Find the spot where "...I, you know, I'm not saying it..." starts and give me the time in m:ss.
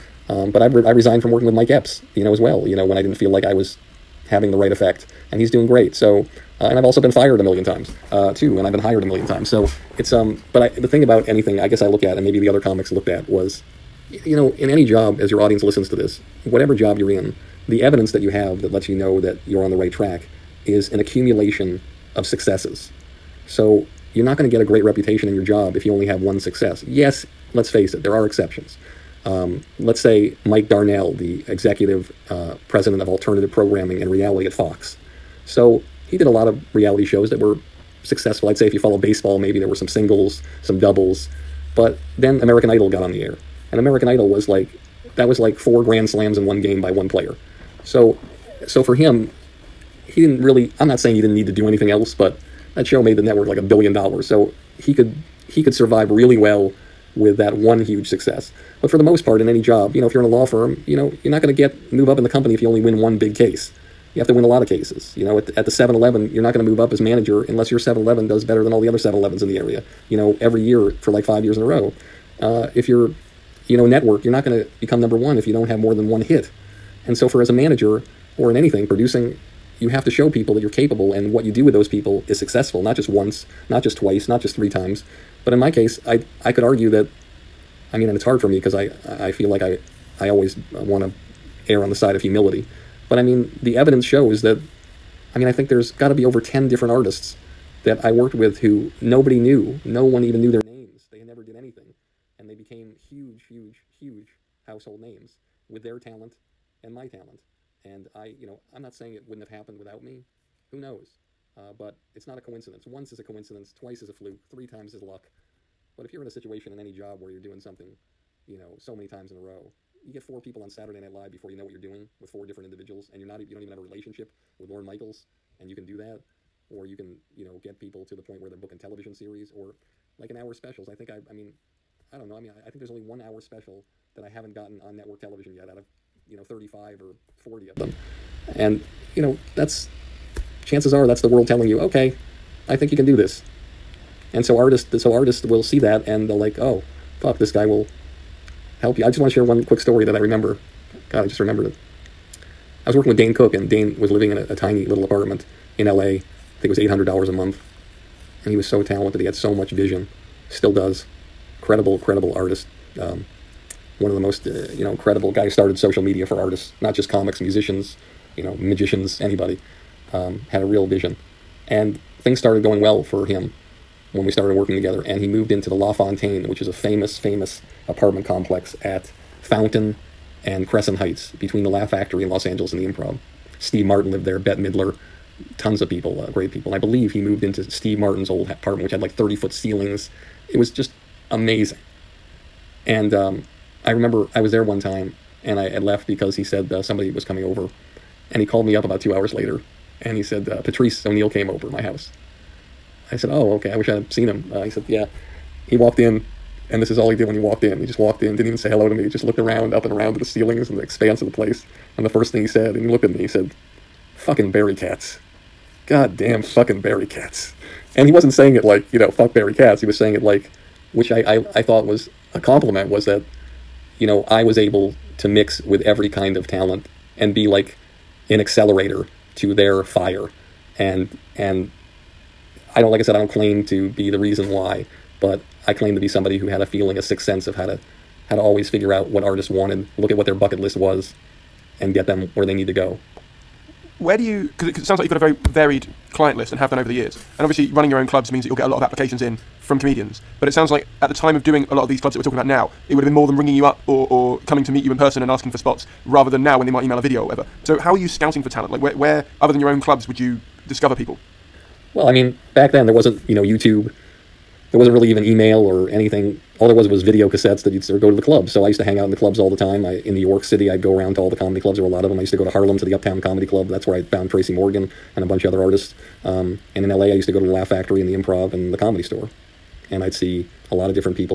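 1:48.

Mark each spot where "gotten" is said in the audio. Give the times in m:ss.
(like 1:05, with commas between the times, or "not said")
2:14.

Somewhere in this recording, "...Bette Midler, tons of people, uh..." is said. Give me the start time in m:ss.
3:04.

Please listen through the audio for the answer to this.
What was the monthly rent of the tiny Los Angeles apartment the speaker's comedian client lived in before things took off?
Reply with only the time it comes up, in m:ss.
2:36.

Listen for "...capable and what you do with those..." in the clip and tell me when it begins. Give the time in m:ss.
1:20.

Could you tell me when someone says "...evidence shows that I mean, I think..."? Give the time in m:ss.
1:33.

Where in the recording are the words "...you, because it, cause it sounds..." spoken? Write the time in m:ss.
4:04.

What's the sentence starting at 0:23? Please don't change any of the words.
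So you're not going to get a great reputation in your job if you only have one success.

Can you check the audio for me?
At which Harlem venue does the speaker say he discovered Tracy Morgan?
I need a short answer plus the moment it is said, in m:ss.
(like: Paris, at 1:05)
Uptown Comedy Club, at 4:32.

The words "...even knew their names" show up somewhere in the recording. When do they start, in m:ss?
1:40.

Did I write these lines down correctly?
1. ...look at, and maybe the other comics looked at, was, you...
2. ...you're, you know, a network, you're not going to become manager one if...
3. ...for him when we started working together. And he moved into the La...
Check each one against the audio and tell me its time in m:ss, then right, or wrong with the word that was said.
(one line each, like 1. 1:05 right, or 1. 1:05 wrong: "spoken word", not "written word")
1. 0:11 right
2. 1:12 wrong: "number", not "manager"
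3. 2:53 right.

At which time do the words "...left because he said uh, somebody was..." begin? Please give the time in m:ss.
3:15.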